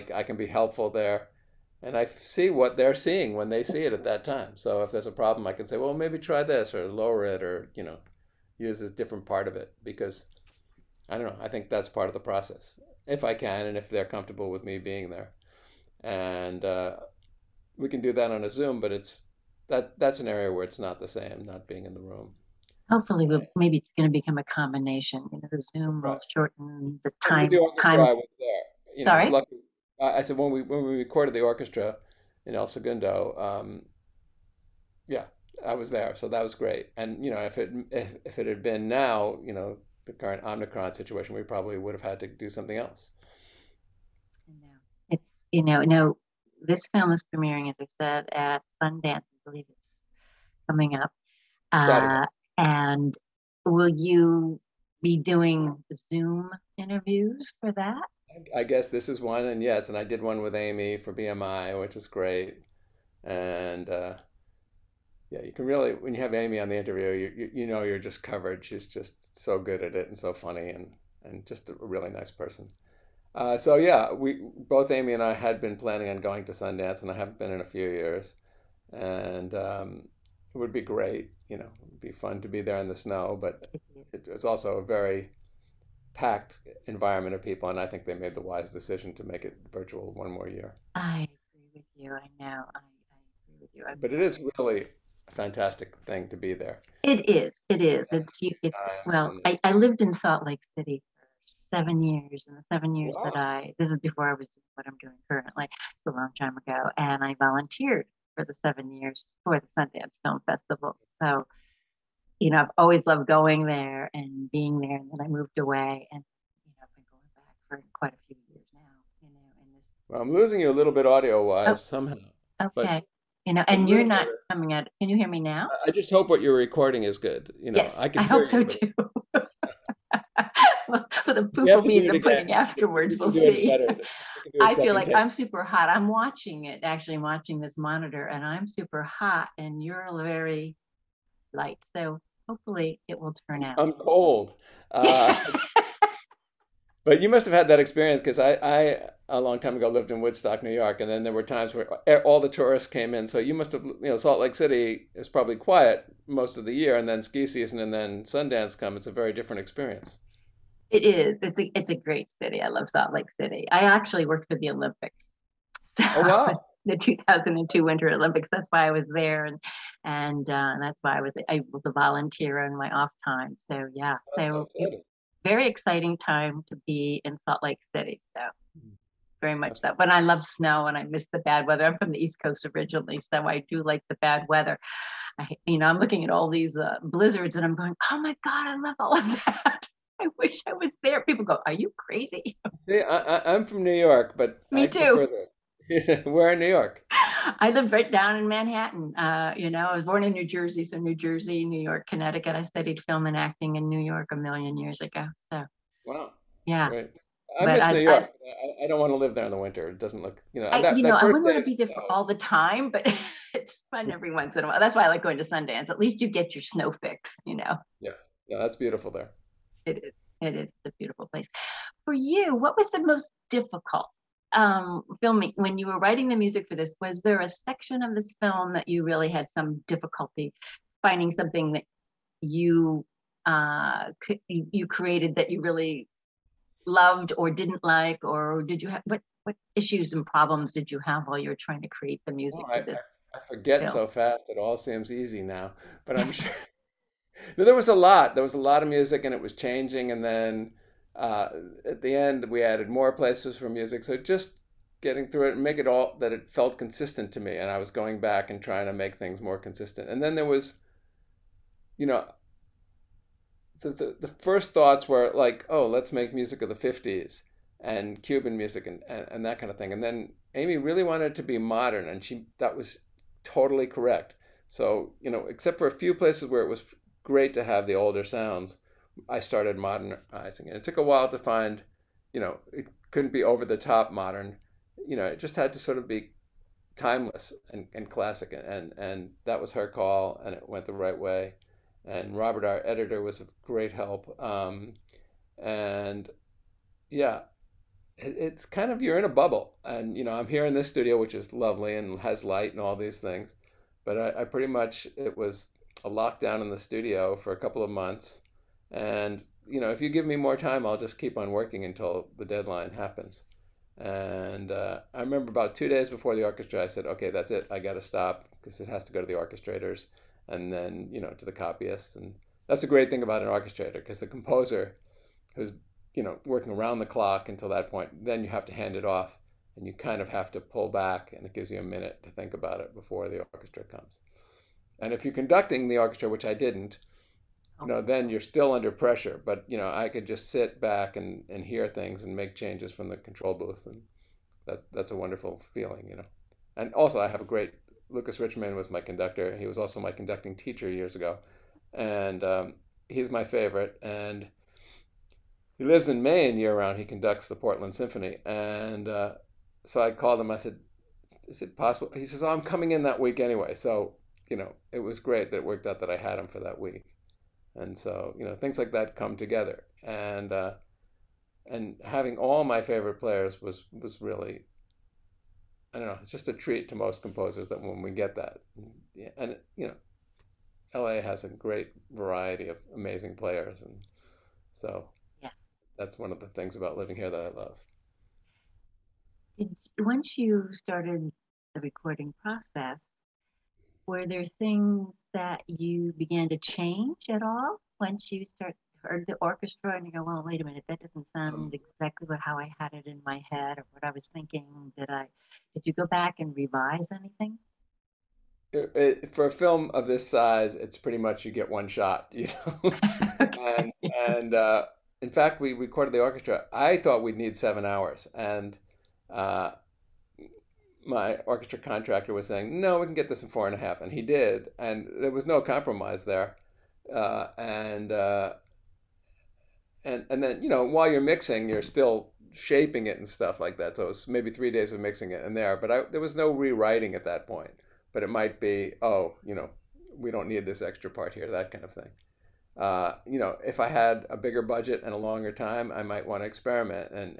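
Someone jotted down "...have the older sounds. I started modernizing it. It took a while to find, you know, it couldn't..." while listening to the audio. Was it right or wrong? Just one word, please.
right.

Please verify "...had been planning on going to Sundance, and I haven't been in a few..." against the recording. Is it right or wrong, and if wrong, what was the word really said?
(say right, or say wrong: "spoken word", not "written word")
right.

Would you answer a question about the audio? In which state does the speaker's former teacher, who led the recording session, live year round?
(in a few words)
Maine.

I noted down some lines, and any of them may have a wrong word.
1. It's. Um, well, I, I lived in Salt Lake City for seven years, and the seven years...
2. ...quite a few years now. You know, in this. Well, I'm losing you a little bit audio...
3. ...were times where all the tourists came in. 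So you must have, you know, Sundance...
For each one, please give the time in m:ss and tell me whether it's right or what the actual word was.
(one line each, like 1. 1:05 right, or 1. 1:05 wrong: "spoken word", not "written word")
1. 1:38 right
2. 1:57 right
3. 2:31 wrong: "Salt", not "Sundance".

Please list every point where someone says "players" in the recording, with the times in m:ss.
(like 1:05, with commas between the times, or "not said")
6:13, 6:23.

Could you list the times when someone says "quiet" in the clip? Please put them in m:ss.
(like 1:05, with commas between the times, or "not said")
2:35.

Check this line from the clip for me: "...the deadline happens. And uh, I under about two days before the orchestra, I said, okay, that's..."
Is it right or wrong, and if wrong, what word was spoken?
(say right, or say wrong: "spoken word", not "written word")
wrong: "remember", not "under".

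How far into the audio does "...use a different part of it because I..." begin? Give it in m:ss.
0:08.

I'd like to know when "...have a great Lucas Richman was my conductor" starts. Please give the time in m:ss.
5:47.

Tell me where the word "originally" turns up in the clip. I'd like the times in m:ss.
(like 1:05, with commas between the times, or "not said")
3:02.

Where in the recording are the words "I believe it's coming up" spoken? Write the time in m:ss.
0:49.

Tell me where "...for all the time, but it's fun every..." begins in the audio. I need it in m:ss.
3:31.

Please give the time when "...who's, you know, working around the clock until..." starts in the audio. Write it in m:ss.
5:25.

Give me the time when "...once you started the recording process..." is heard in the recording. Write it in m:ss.
6:29.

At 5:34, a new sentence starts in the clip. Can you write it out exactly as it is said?
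And if you're conducting the orchestra, which I didn't, you know, then you're still under pressure.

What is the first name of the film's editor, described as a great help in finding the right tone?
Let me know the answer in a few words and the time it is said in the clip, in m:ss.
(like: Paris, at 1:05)
Robert, at 4:52.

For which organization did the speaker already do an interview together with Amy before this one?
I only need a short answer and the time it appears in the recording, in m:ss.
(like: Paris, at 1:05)
BMI, at 1:01.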